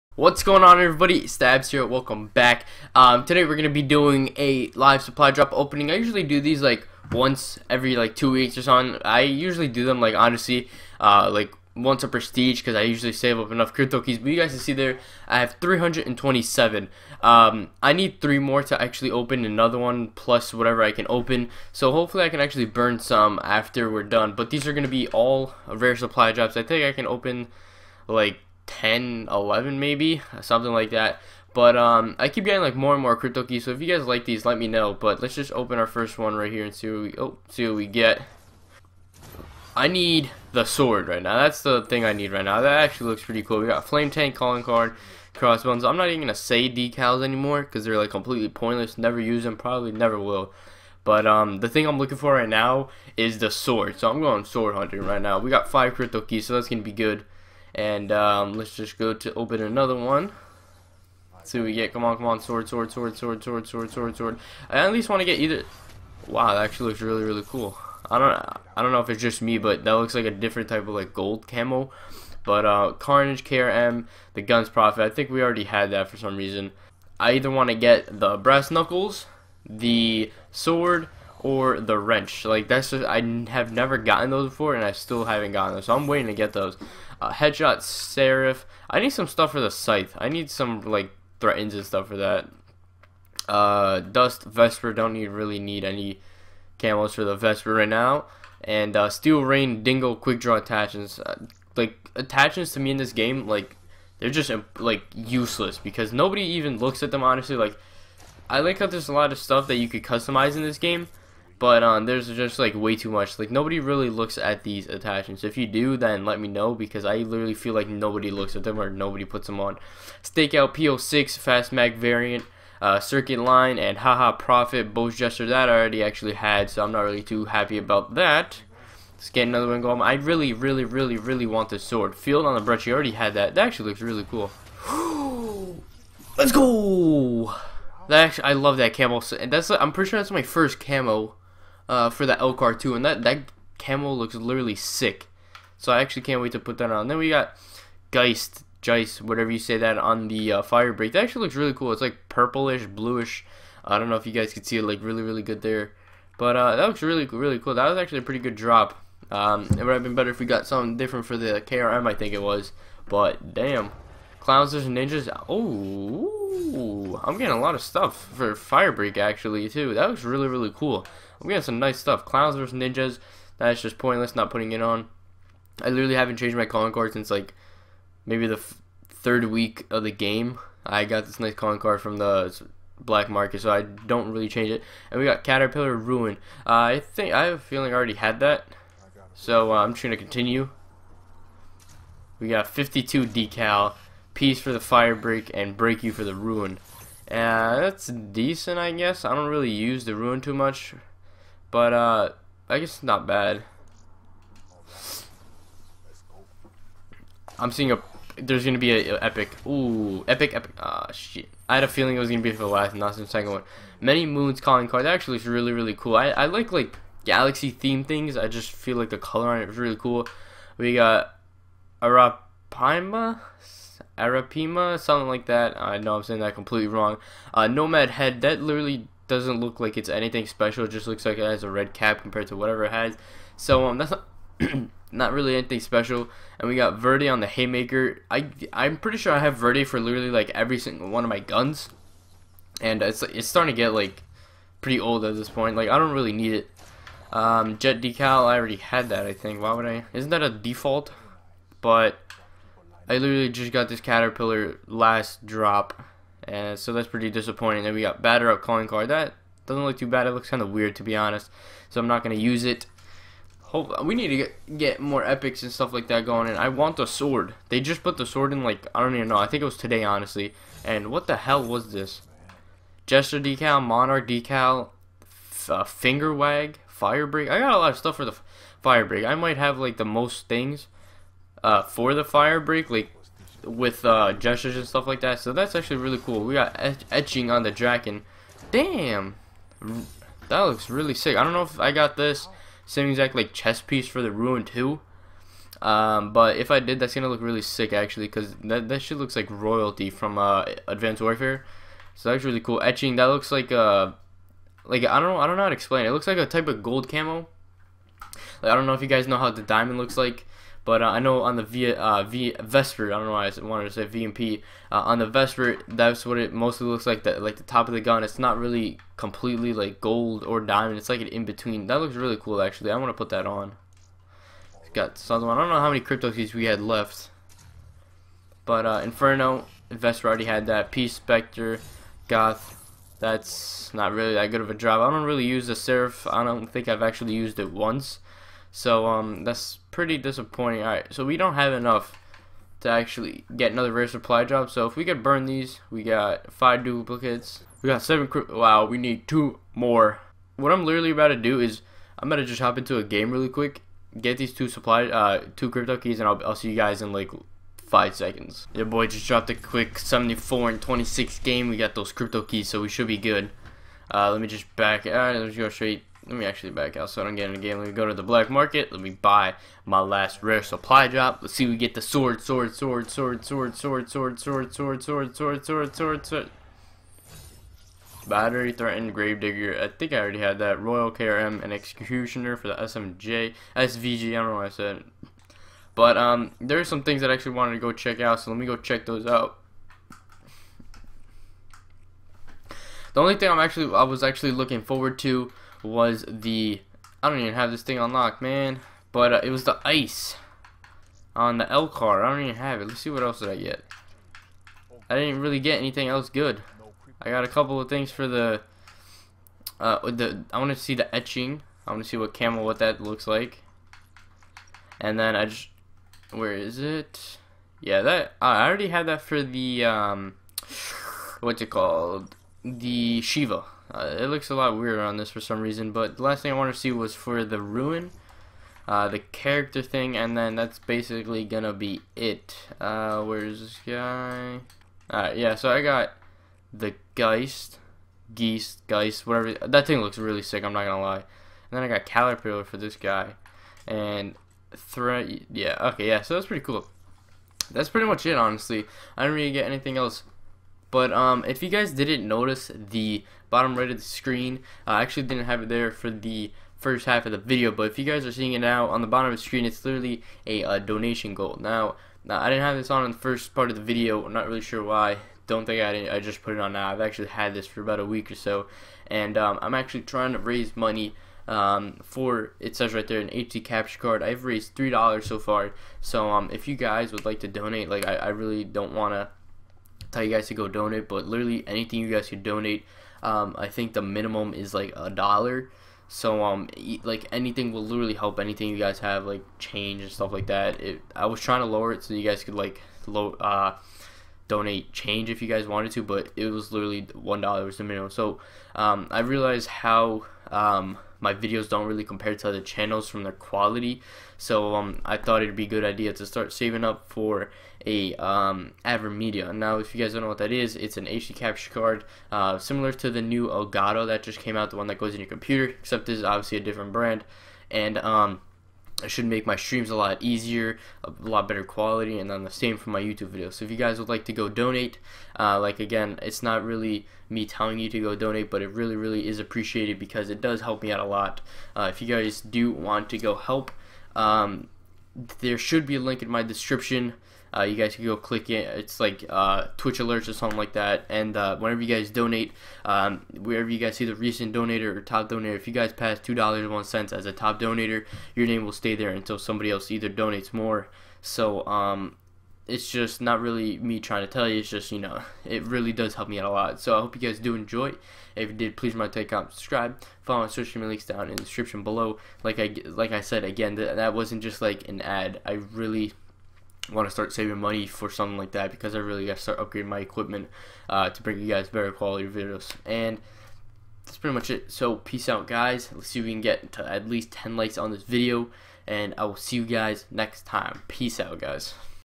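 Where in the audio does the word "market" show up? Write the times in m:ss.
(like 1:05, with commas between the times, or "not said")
3:03, 6:08.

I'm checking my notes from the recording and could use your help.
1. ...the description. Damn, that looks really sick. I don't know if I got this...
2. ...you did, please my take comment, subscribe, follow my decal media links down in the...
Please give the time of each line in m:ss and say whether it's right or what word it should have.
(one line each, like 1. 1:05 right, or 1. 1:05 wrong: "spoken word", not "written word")
1. 4:47 wrong: "dragon", not "description"
2. 9:18 wrong: "social", not "decal".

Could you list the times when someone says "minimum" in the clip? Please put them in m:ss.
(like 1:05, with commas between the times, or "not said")
8:04, 8:17.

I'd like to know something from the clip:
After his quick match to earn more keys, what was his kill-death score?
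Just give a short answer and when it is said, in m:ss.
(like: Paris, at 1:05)
74 and 26, at 5:59.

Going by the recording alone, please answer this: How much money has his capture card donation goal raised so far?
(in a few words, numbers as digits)
3 dollars.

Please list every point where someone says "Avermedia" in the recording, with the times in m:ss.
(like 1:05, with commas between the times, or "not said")
8:28.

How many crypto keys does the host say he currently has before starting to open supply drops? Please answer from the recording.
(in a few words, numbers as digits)
327.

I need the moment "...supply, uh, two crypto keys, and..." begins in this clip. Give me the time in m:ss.
5:54.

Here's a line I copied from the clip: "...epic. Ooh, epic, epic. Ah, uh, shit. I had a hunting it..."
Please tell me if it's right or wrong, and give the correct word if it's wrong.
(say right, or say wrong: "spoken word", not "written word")
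wrong: "feeling", not "hunting".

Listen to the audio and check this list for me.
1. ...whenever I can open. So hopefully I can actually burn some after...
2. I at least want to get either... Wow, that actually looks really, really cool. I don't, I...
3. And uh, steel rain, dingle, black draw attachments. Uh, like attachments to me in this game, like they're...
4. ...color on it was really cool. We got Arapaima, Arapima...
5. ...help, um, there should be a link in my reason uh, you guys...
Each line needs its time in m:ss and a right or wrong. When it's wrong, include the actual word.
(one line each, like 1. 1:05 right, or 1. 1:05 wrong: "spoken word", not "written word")
1. 0:20 wrong: "whatever", not "whenever"
2. 1:04 right
3. 1:38 wrong: "quick", not "black"
4. 3:39 right
5. 8:53 wrong: "description", not "reason".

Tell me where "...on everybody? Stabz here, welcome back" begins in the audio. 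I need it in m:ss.
0:00.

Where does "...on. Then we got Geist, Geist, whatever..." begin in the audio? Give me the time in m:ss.
2:26.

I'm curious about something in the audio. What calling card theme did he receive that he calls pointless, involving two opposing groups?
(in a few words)
Clowns and ninjas.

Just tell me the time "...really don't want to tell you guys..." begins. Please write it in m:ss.
7:58.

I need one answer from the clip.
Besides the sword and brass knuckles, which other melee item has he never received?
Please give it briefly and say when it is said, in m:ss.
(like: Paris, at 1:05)
The wrench, at 1:21.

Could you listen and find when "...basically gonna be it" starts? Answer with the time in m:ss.
7:10.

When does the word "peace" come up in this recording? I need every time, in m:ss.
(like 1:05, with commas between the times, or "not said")
3:14, 5:30, 9:34, 9:40.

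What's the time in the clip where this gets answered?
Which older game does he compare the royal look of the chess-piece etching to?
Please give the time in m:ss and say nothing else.
5:00.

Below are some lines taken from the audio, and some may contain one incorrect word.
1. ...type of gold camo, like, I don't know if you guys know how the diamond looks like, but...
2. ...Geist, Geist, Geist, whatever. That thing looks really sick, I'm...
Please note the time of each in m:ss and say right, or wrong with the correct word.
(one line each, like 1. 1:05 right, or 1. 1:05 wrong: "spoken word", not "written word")
1. 5:06 right
2. 7:17 right.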